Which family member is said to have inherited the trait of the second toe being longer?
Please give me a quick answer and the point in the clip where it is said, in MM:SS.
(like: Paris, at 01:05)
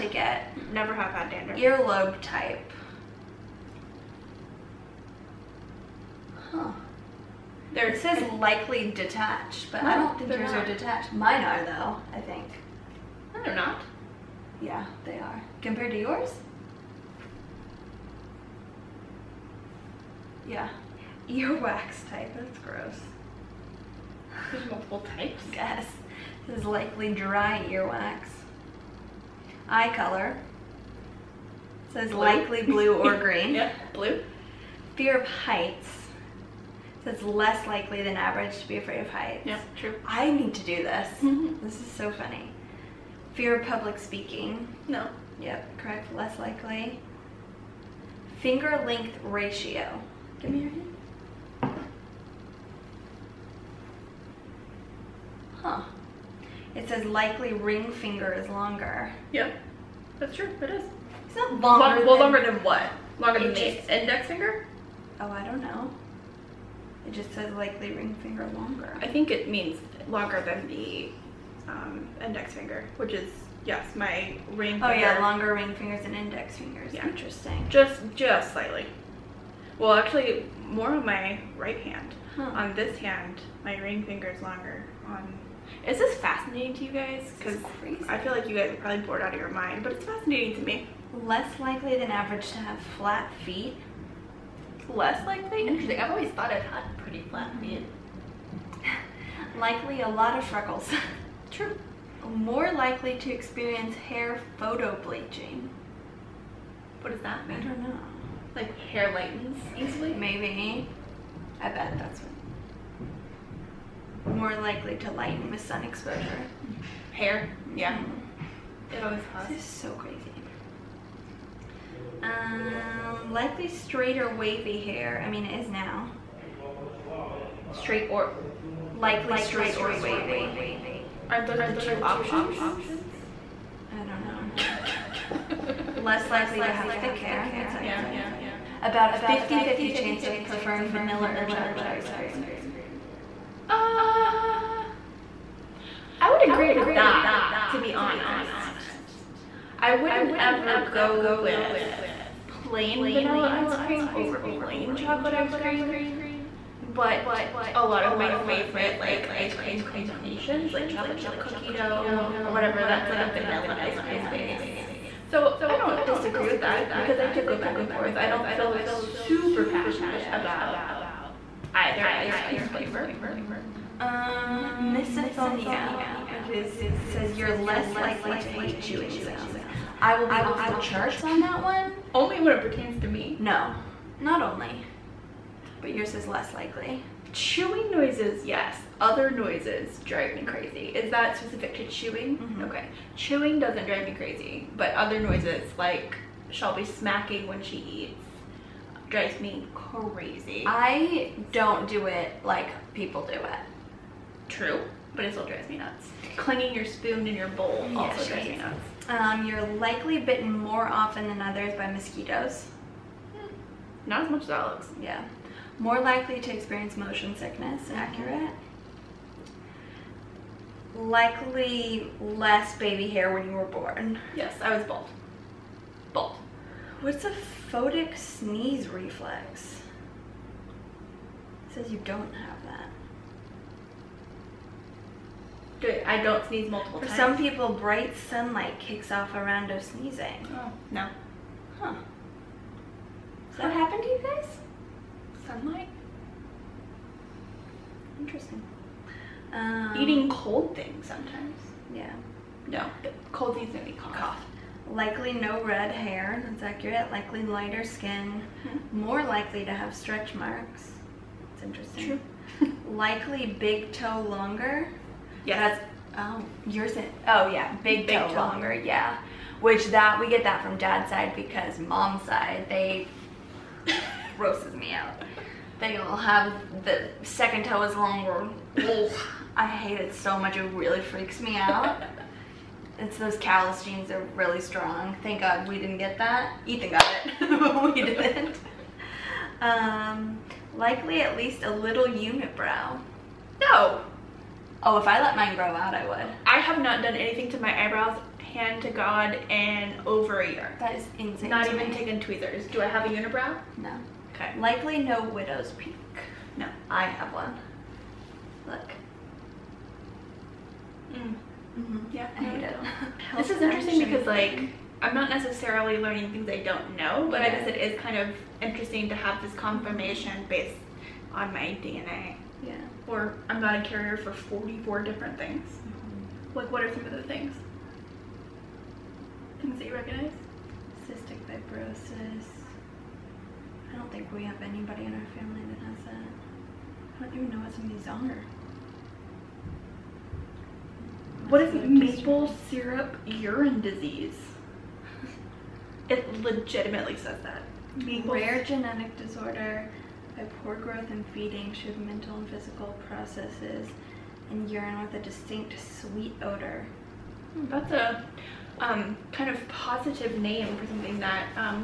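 Ethan, at 04:46.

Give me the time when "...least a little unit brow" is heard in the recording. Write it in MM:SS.
04:51.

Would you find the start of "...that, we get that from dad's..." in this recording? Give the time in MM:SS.
04:29.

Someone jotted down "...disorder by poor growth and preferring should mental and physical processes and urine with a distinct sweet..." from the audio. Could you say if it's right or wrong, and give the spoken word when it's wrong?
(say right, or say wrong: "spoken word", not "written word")
wrong: "feeding", not "preferring".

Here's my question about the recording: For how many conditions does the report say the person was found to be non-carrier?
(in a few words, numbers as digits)
44.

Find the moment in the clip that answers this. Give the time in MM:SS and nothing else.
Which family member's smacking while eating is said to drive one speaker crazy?
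03:16.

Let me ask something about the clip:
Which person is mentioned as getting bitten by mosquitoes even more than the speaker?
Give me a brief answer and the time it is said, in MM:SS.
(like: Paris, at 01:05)
Alex, at 03:34.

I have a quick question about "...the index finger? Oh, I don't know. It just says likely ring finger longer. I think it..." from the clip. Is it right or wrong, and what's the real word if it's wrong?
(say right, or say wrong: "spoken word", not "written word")
right.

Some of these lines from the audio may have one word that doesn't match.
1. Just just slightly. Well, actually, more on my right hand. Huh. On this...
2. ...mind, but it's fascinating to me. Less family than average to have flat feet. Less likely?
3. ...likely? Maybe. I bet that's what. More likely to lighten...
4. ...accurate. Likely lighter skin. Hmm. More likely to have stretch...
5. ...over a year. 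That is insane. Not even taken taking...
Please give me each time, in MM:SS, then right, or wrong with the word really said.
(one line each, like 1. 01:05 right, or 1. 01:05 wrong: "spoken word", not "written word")
1. 01:17 right
2. 01:29 wrong: "likely", not "family"
3. 01:49 wrong: "easily", not "likely"
4. 04:16 right
5. 05:00 right.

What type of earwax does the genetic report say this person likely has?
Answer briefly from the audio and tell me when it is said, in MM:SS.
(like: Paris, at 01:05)
Dry earwax, at 00:27.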